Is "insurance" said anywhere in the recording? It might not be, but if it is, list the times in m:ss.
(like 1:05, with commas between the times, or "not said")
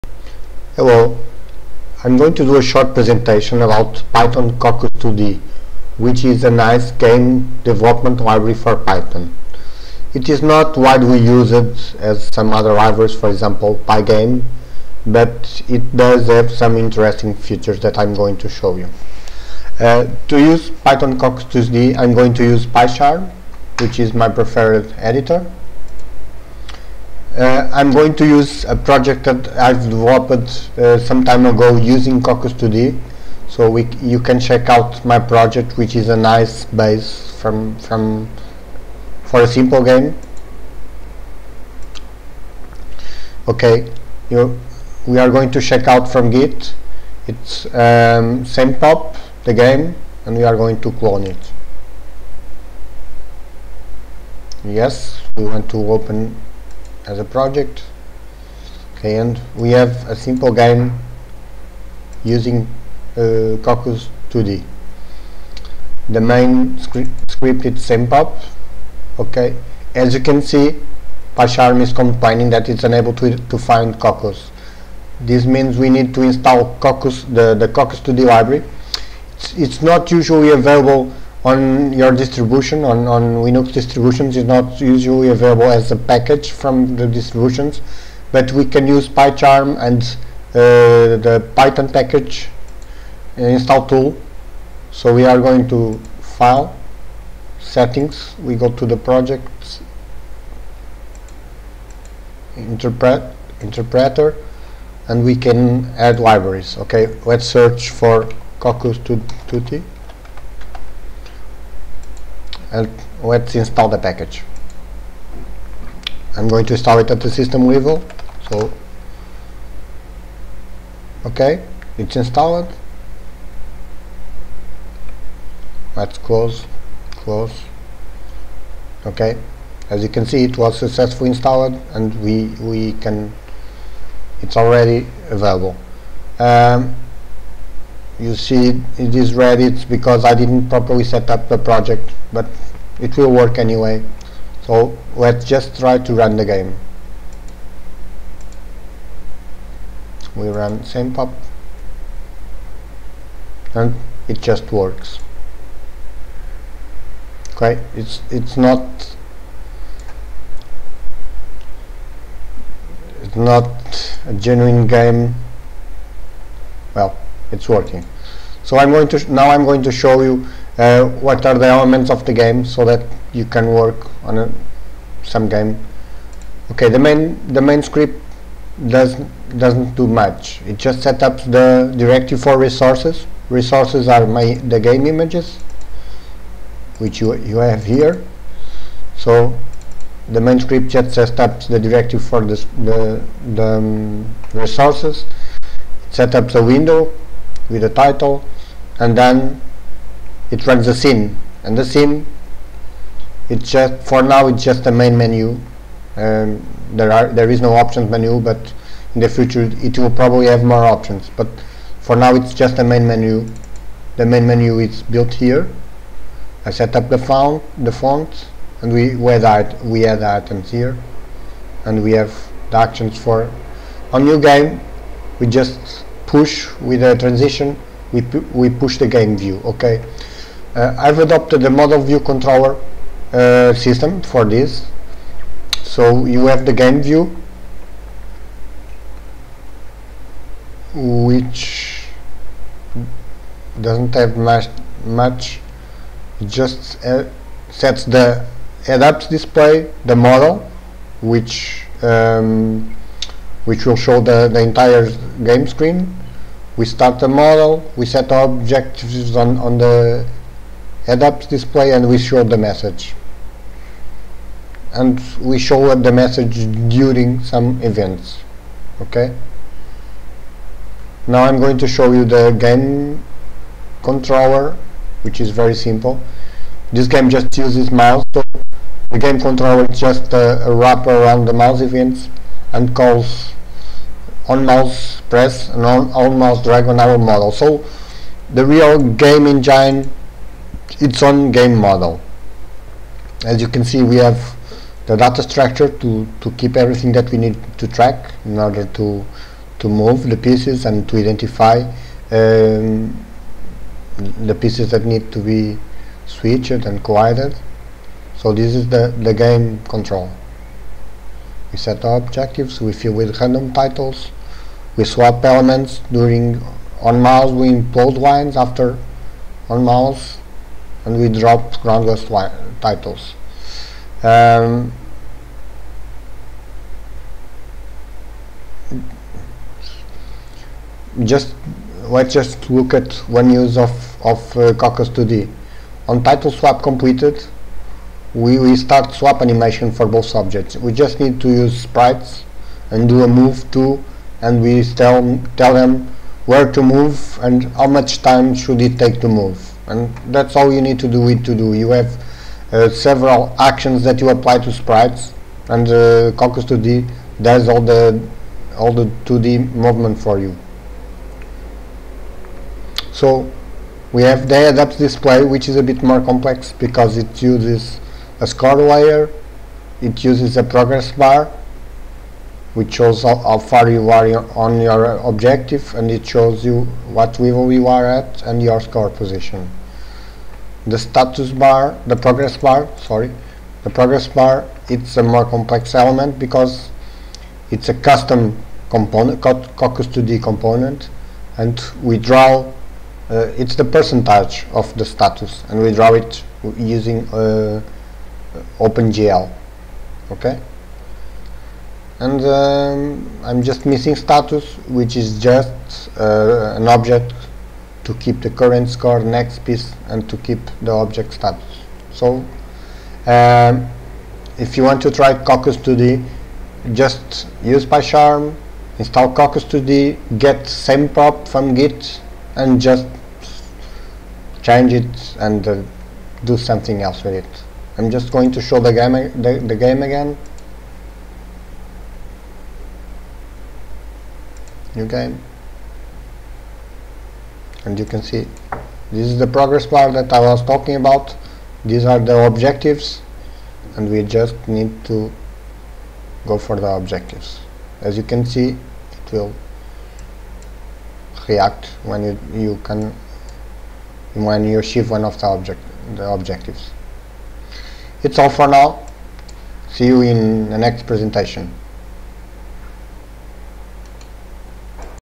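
not said.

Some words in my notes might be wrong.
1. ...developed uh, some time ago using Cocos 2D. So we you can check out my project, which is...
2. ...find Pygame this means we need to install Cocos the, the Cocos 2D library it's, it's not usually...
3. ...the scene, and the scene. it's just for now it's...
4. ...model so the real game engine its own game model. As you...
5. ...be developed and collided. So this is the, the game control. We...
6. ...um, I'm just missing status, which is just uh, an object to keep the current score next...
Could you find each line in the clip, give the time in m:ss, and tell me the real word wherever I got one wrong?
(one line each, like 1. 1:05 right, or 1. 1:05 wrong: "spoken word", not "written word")
1. 0:29 right
2. 1:13 wrong: "Cocos", not "Pygame"
3. 3:20 right
4. 4:47 right
5. 5:05 wrong: "switched", not "developed"
6. 6:42 right.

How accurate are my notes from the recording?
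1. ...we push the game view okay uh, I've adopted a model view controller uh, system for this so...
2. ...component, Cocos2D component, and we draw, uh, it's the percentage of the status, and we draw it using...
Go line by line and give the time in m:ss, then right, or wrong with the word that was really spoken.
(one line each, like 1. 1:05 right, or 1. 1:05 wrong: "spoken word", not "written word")
1. 3:48 right
2. 6:28 right.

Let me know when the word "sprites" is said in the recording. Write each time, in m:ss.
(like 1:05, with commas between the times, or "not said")
5:41, 5:54.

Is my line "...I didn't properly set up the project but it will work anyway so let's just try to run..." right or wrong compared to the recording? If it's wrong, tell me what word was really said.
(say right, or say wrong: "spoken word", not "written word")
right.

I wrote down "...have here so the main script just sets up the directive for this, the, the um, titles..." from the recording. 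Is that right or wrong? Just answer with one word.
wrong.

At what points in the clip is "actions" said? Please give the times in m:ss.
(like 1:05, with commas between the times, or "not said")
3:42, 5:53.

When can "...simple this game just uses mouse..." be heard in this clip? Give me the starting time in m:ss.
4:35.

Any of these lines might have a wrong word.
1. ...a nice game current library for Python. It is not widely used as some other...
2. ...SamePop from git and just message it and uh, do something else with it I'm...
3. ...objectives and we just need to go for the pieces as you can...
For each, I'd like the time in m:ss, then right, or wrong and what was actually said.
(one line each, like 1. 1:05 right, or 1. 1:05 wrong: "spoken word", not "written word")
1. 0:06 wrong: "development", not "current"
2. 7:00 wrong: "change", not "message"
3. 7:22 wrong: "objectives", not "pieces".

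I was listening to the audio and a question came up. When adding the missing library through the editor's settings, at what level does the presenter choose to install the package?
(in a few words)
system level.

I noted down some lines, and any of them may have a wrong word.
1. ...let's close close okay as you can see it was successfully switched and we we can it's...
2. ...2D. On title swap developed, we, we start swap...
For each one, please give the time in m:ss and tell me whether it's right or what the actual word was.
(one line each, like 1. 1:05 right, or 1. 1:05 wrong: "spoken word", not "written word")
1. 2:05 wrong: "installed", not "switched"
2. 5:35 wrong: "completed", not "developed".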